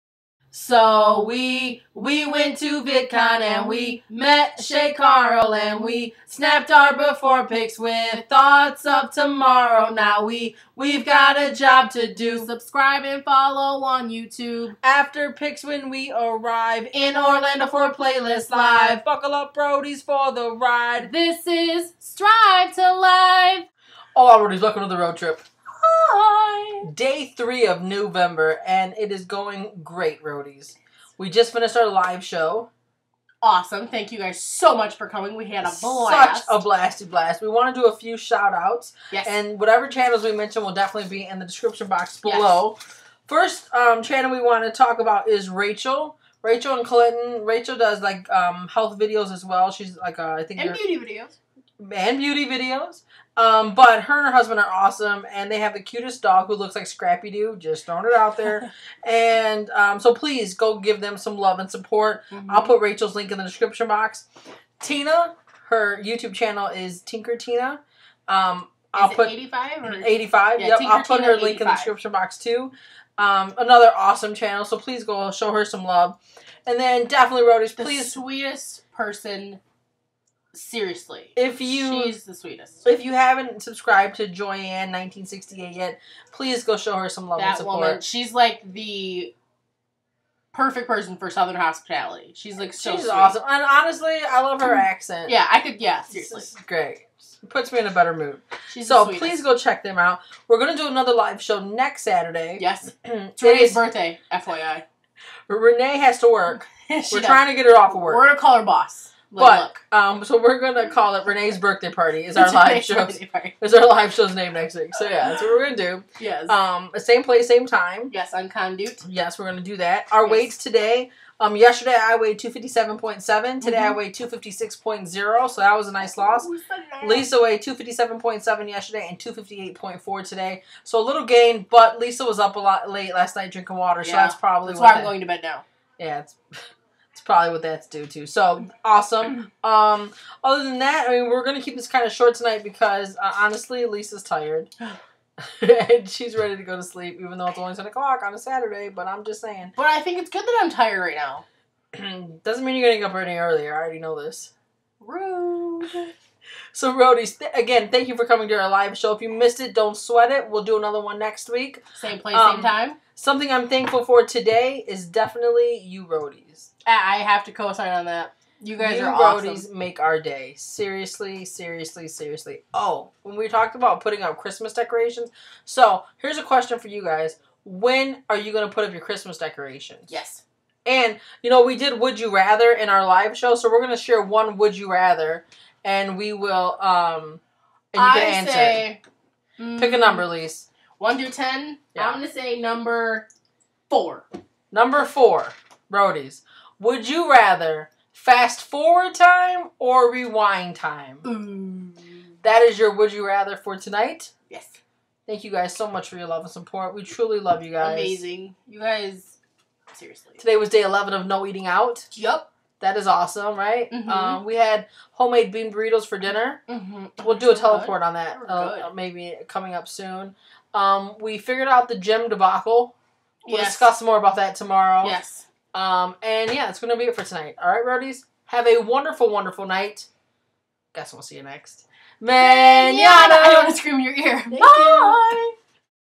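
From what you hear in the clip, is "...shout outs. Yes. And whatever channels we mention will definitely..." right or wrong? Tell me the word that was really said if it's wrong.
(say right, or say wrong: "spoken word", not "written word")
right.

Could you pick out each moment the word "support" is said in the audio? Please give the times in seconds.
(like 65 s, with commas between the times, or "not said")
61 s, 87 s, 206 s.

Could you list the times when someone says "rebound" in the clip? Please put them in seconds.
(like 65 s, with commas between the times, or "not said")
not said.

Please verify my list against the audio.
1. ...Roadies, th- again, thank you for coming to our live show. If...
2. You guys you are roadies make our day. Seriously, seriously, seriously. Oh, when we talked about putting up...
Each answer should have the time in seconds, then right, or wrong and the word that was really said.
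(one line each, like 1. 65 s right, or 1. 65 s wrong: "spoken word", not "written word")
1. 156 s right
2. 168 s right.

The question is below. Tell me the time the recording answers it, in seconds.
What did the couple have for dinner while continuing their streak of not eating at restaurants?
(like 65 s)
215 s.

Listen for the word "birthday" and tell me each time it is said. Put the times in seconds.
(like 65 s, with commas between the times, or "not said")
103 s, 111 s.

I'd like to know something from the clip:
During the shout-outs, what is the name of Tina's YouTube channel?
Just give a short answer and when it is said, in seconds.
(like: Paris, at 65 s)
Tinker Tina, at 67 s.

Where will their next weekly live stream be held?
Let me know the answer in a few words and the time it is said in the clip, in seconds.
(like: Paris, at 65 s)
Conduit, at 118 s.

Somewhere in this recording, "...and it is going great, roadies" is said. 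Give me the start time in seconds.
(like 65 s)
28 s.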